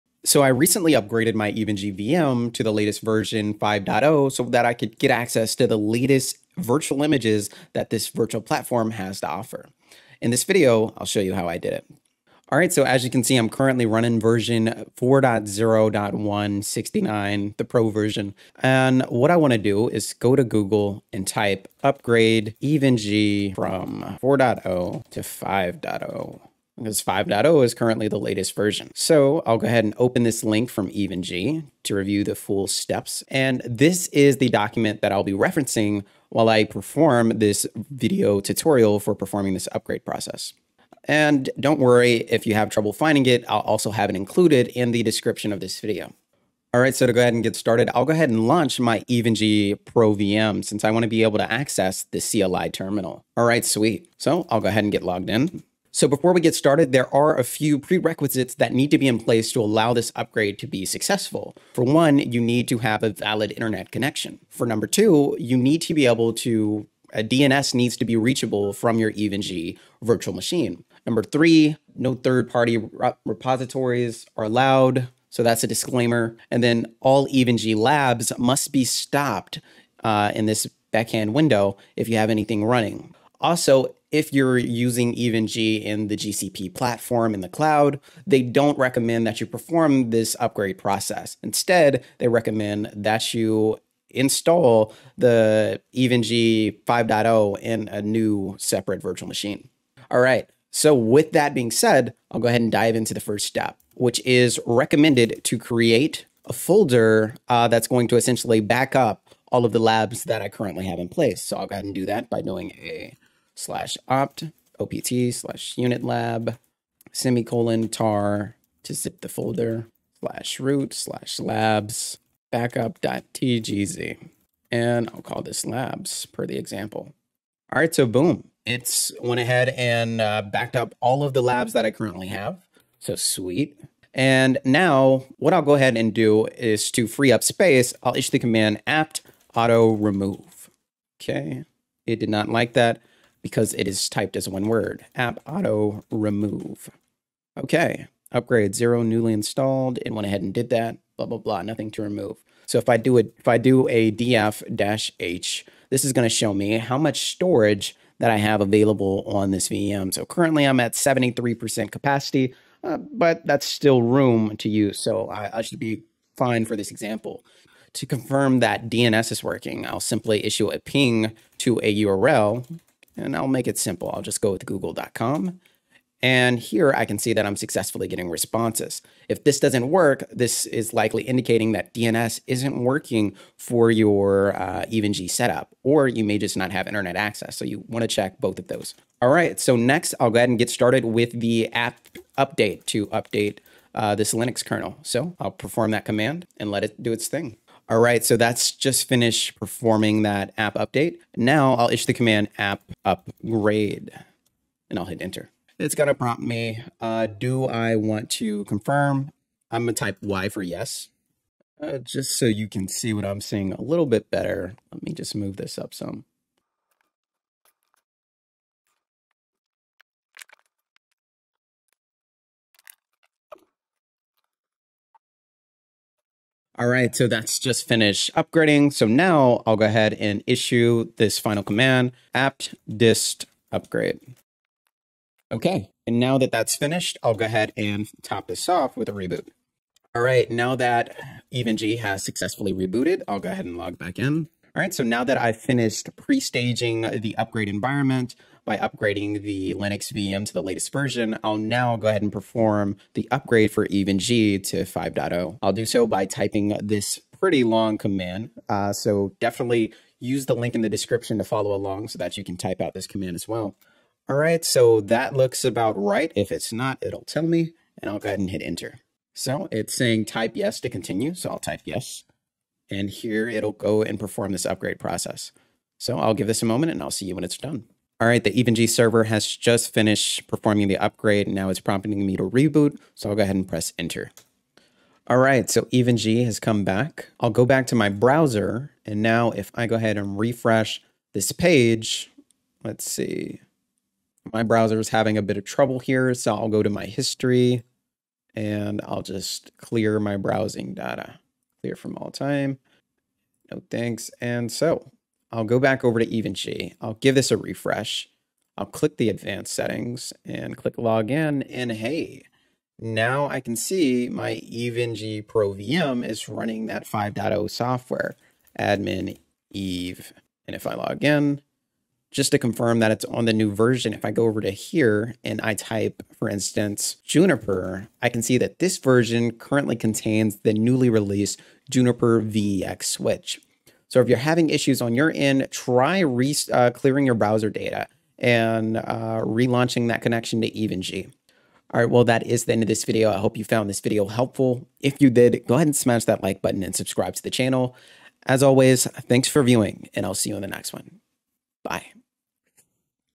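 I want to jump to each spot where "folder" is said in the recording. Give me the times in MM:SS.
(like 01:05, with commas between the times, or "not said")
01:46, 01:59.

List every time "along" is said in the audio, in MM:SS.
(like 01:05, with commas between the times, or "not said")
04:21.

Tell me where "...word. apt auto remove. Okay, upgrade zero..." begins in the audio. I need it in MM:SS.
02:24.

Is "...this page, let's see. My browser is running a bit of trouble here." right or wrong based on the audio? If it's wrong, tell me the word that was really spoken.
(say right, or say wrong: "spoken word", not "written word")
wrong: "having", not "running".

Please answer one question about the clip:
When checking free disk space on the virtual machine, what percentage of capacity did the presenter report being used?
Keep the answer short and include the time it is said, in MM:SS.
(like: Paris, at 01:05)
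73%, at 02:40.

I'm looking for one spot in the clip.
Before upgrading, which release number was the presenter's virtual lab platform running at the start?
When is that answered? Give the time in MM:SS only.
00:14.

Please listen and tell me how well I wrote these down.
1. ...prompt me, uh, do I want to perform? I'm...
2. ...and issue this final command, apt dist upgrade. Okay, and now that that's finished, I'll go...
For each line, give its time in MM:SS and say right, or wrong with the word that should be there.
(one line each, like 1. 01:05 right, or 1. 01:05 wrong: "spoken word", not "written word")
1. 03:26 wrong: "confirm", not "perform"
2. 03:50 right.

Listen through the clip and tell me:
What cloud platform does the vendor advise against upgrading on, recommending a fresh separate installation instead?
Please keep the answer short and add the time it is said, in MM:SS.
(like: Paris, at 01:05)
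GCP, at 01:26.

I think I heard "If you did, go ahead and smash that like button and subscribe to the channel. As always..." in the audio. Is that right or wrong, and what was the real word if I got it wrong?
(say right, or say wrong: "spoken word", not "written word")
right.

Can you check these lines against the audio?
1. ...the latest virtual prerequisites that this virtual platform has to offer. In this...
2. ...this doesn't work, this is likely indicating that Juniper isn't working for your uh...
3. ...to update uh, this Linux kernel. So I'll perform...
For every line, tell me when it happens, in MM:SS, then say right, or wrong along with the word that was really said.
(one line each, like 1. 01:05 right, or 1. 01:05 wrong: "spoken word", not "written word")
1. 00:05 wrong: "images", not "prerequisites"
2. 02:59 wrong: "DNS", not "Juniper"
3. 03:12 right.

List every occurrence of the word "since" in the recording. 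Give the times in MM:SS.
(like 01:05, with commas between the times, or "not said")
00:50.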